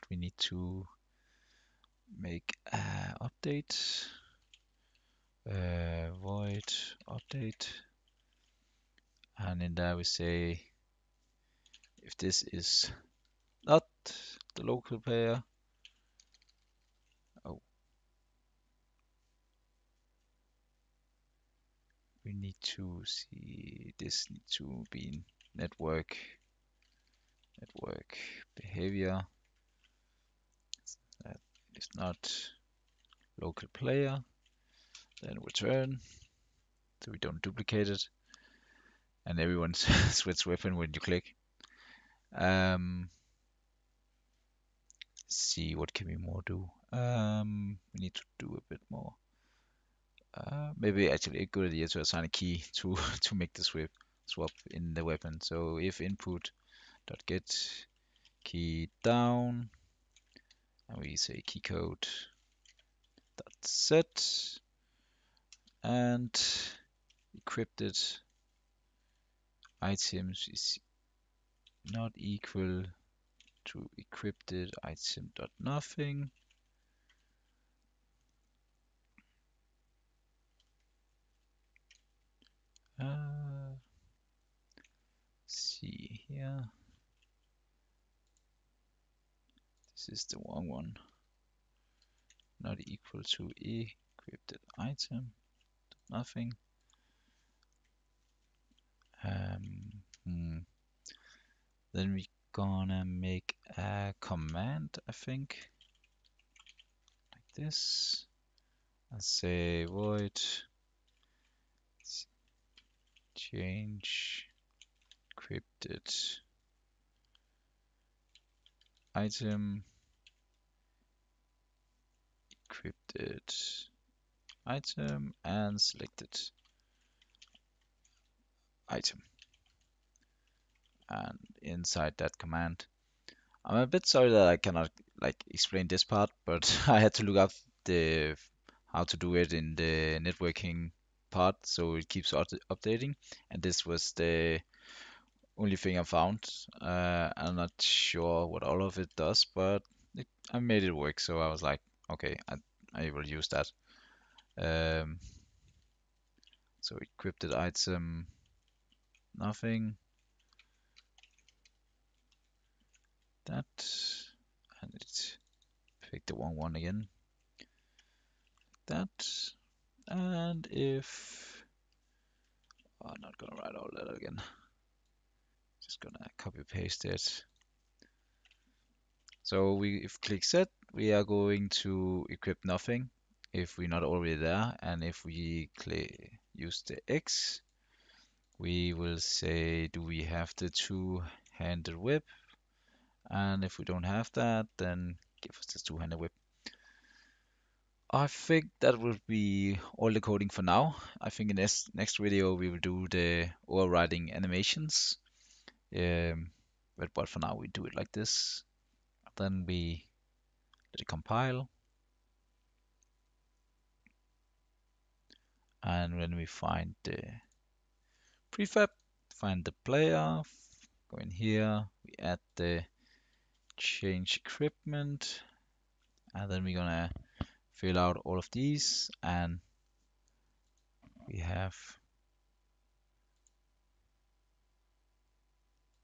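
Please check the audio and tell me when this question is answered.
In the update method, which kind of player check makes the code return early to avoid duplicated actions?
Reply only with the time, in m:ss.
0:31.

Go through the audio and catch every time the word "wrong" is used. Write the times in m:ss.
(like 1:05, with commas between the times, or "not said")
1:30, 2:46.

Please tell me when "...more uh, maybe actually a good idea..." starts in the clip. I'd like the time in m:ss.
0:48.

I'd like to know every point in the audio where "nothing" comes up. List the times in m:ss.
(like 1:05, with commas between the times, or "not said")
1:15, 1:36, 2:39, 3:02.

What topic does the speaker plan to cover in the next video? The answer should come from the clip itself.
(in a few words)
Overriding animations.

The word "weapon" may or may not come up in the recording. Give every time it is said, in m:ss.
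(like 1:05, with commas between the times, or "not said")
0:40, 0:55.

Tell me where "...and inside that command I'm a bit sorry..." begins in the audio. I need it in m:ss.
2:11.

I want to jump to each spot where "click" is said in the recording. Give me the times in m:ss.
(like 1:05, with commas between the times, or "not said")
0:41, 3:00, 3:05.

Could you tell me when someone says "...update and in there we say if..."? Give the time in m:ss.
0:07.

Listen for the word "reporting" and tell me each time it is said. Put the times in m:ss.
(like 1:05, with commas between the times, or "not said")
not said.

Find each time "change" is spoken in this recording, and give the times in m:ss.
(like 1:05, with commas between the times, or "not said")
1:53, 3:43.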